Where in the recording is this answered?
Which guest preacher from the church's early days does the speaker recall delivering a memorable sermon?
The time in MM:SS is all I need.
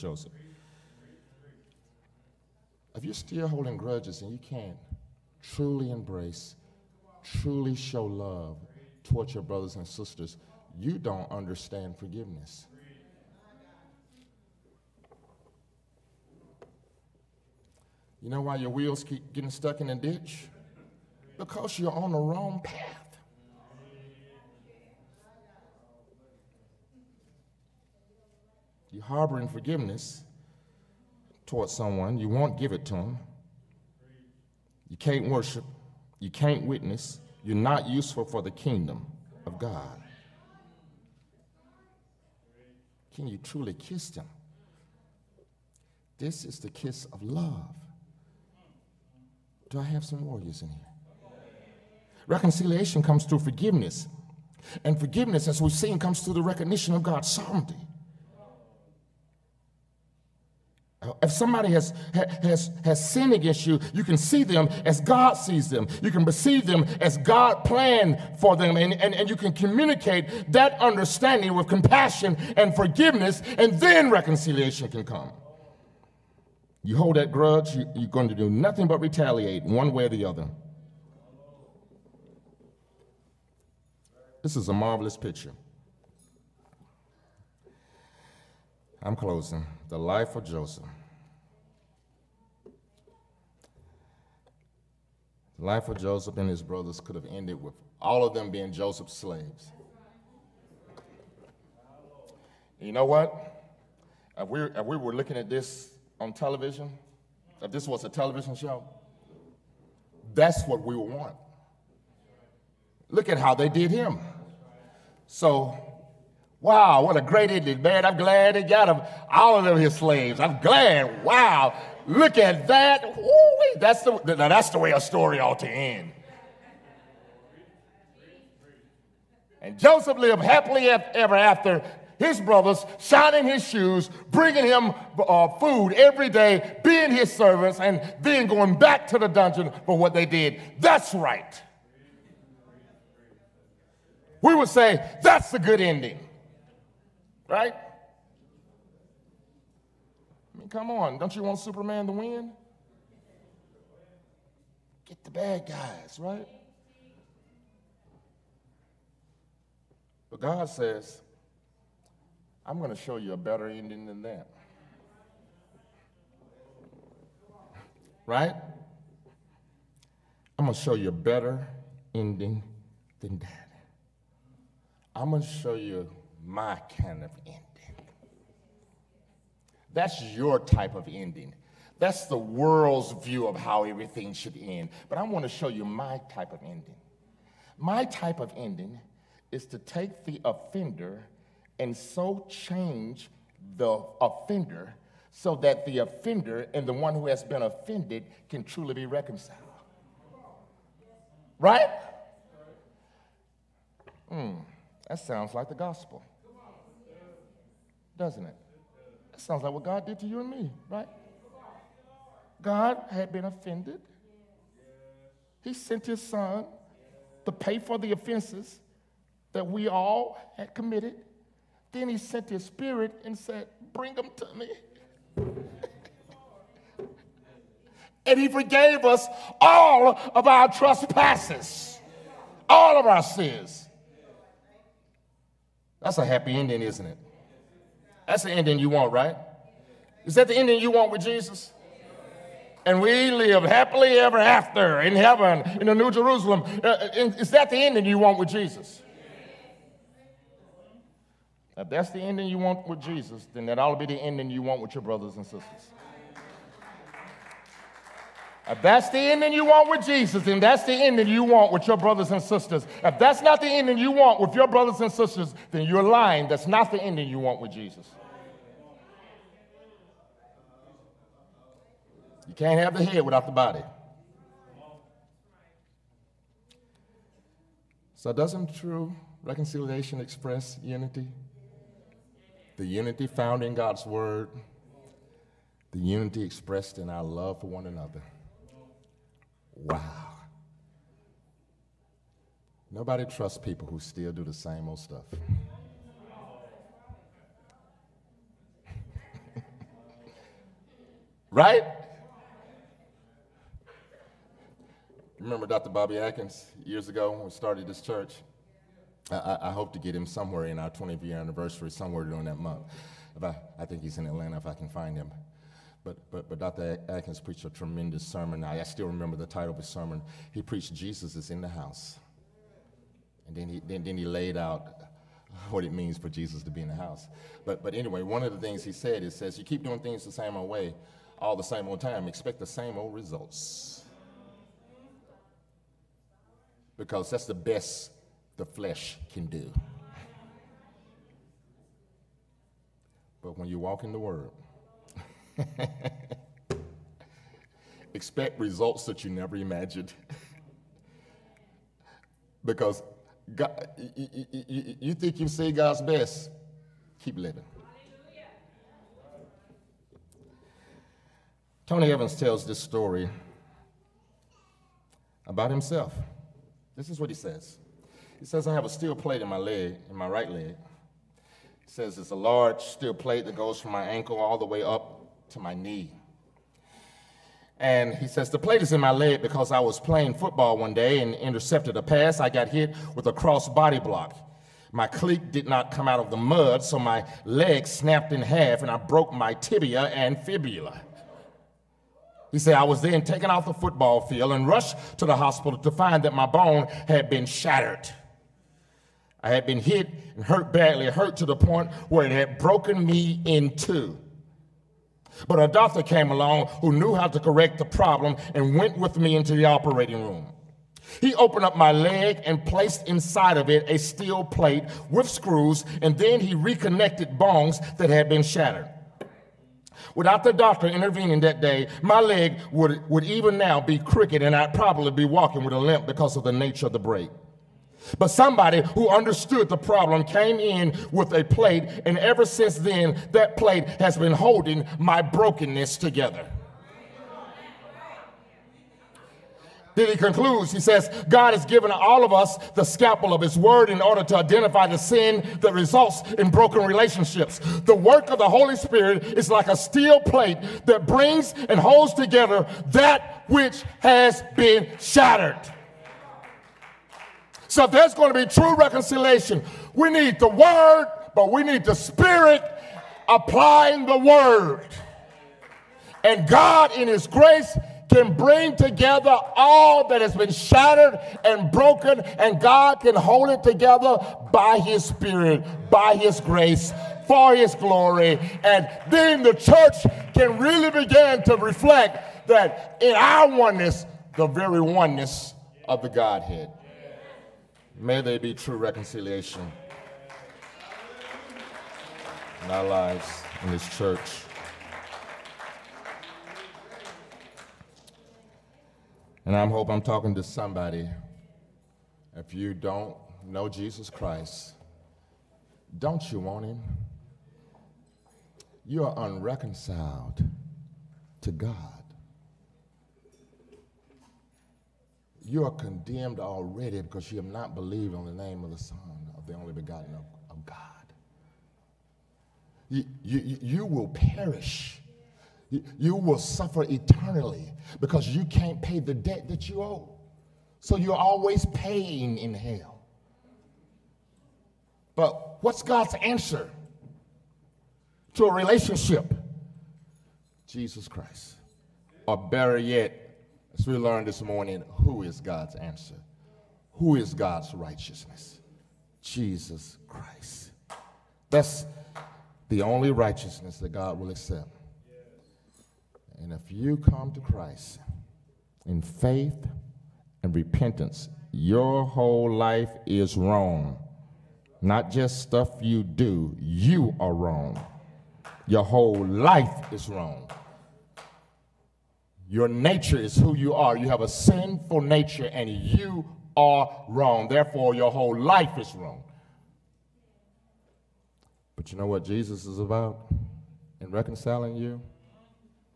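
05:05.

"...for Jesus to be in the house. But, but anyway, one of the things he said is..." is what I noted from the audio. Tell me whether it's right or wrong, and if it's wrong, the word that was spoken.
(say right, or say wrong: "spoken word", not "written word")
right.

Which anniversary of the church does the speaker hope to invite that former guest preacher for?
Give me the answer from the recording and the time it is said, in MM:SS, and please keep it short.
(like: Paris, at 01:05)
20th, at 05:10.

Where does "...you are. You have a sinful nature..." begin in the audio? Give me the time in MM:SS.
09:33.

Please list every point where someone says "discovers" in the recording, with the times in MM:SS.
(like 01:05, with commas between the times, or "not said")
not said.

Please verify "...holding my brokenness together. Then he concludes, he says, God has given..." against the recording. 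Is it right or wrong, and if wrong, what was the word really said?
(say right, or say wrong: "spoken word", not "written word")
right.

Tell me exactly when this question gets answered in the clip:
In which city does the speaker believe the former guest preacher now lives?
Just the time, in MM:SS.
05:14.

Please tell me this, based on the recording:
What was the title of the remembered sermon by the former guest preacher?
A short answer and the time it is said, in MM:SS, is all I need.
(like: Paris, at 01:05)
Jesus is in the house, at 05:20.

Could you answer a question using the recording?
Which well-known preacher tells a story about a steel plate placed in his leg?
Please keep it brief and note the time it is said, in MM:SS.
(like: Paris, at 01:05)
Tony Evans, at 06:01.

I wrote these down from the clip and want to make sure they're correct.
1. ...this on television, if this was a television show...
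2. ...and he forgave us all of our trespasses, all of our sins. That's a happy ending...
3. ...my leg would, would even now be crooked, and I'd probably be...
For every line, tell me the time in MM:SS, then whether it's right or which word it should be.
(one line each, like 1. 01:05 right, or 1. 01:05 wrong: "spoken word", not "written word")
1. 01:45 right
2. 03:48 right
3. 07:02 right.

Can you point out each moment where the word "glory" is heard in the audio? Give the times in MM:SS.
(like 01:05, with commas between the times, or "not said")
07:57.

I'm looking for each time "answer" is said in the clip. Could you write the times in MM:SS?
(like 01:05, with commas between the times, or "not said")
08:56, 09:05.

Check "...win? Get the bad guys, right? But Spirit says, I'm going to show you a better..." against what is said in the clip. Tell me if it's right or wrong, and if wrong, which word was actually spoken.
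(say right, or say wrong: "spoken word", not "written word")
wrong: "God", not "Spirit".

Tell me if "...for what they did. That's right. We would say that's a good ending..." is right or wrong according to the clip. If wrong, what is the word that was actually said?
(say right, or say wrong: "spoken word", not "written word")
right.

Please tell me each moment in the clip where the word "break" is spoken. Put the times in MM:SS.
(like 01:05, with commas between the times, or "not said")
07:06.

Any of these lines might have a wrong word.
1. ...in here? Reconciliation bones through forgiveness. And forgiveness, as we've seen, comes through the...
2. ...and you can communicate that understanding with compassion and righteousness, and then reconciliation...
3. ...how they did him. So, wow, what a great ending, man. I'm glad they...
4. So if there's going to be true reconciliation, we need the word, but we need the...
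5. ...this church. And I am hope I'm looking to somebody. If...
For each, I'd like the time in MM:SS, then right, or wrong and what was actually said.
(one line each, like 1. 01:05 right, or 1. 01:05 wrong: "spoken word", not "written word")
1. 00:50 wrong: "comes", not "bones"
2. 01:09 wrong: "forgiveness", not "righteousness"
3. 01:53 right
4. 07:37 right
5. 08:13 wrong: "talking", not "looking".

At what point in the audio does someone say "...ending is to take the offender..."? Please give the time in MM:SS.
03:08.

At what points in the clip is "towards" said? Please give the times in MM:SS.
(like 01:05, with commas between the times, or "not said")
00:09, 00:31.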